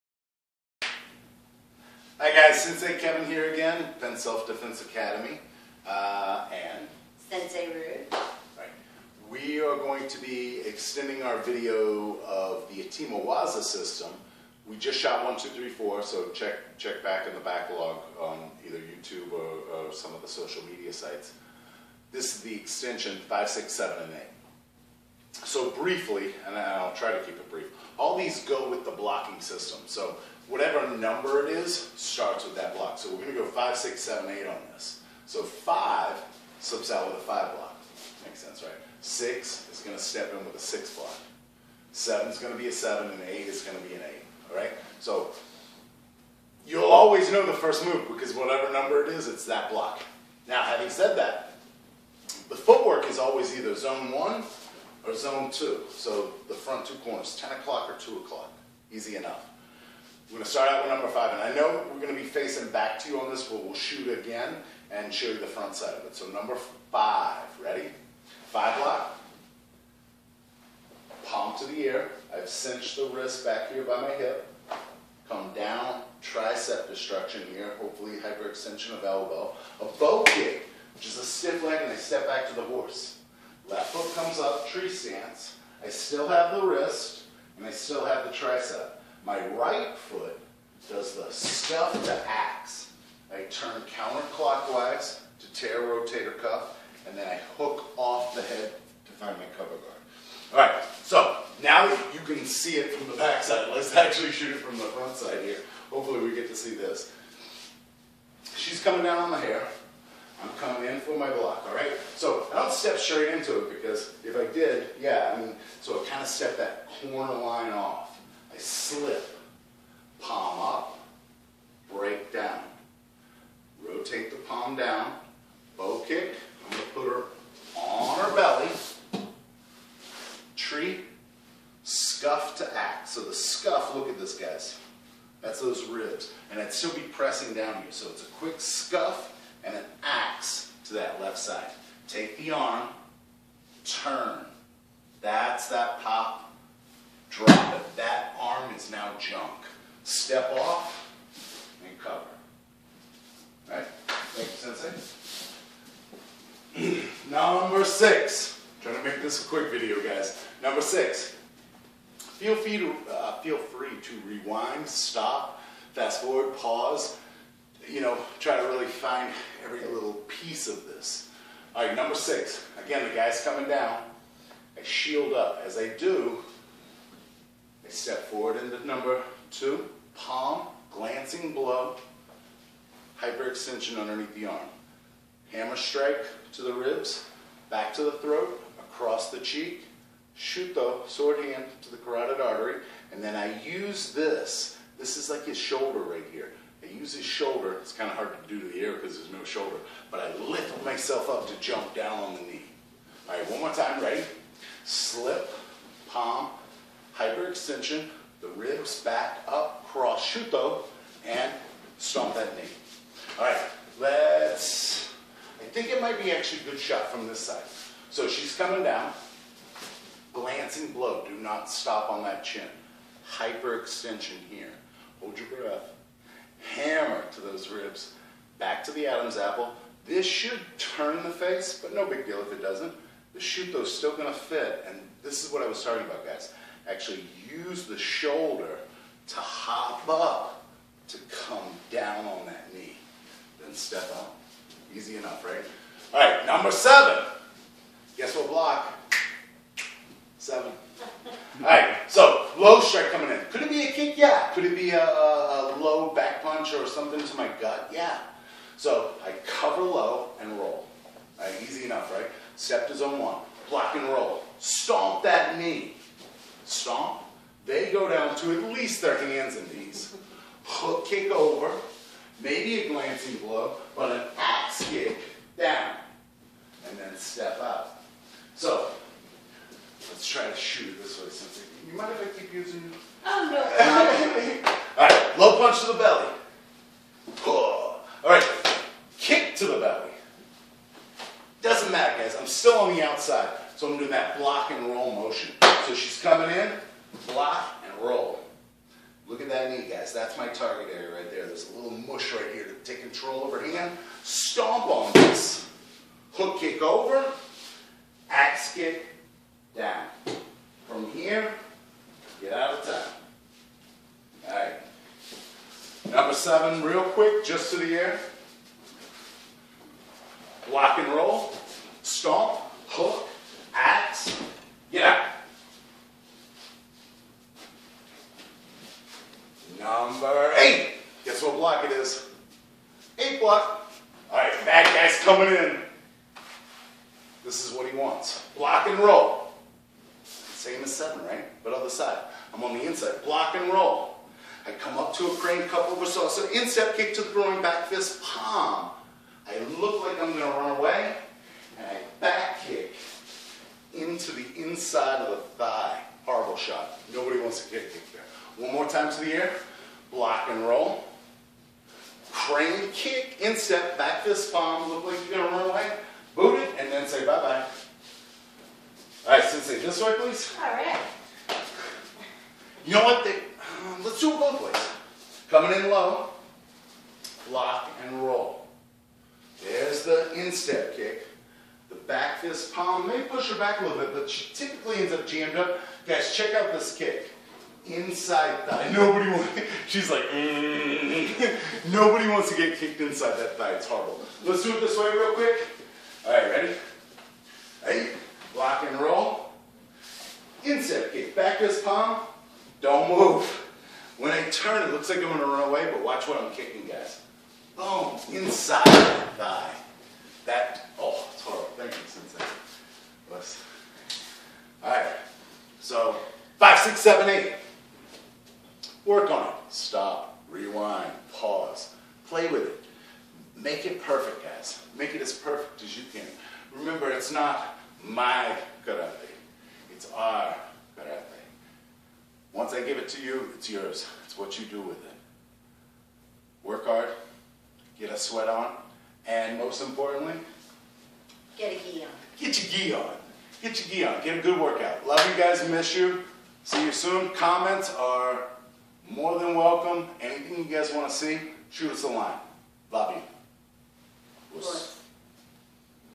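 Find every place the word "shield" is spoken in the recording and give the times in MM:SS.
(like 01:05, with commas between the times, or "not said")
02:54.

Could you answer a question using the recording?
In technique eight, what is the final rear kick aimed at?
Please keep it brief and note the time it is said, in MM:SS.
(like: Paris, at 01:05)
inside of the thigh, at 05:54.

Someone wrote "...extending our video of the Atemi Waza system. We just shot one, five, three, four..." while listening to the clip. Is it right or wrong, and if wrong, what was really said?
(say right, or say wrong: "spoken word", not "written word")
wrong: "two", not "five".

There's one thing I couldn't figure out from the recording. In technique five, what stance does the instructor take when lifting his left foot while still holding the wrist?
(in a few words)
tree stance.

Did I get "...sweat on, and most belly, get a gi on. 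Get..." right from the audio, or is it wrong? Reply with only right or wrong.
wrong.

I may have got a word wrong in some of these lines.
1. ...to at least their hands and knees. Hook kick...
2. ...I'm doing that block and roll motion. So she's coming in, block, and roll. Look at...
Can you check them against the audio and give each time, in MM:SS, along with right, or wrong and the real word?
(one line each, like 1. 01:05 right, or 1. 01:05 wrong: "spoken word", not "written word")
1. 04:28 right
2. 04:53 right.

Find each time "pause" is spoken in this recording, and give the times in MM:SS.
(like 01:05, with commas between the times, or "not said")
02:46.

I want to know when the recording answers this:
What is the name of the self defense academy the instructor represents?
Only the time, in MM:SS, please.
00:03.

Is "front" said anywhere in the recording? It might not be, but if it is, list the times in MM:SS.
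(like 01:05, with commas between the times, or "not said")
00:56, 01:05, 01:44.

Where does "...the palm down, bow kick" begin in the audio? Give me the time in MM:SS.
02:04.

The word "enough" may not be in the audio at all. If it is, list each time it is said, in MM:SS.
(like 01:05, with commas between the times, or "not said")
00:59, 04:05, 04:21.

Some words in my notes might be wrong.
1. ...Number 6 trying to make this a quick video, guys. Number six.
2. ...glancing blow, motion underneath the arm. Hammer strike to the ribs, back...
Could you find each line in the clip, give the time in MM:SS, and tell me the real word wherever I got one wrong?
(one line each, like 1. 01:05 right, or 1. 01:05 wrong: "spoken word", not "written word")
1. 02:37 right
2. 03:00 wrong: "hyperextension", not "motion".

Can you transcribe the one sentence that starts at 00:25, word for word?
So briefly, and I'll try to keep it brief, all these go with the blocking system.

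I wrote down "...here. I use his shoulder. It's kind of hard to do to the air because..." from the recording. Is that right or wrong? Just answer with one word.
right.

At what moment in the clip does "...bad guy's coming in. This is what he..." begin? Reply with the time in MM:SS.
05:34.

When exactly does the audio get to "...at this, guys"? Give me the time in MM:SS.
02:14.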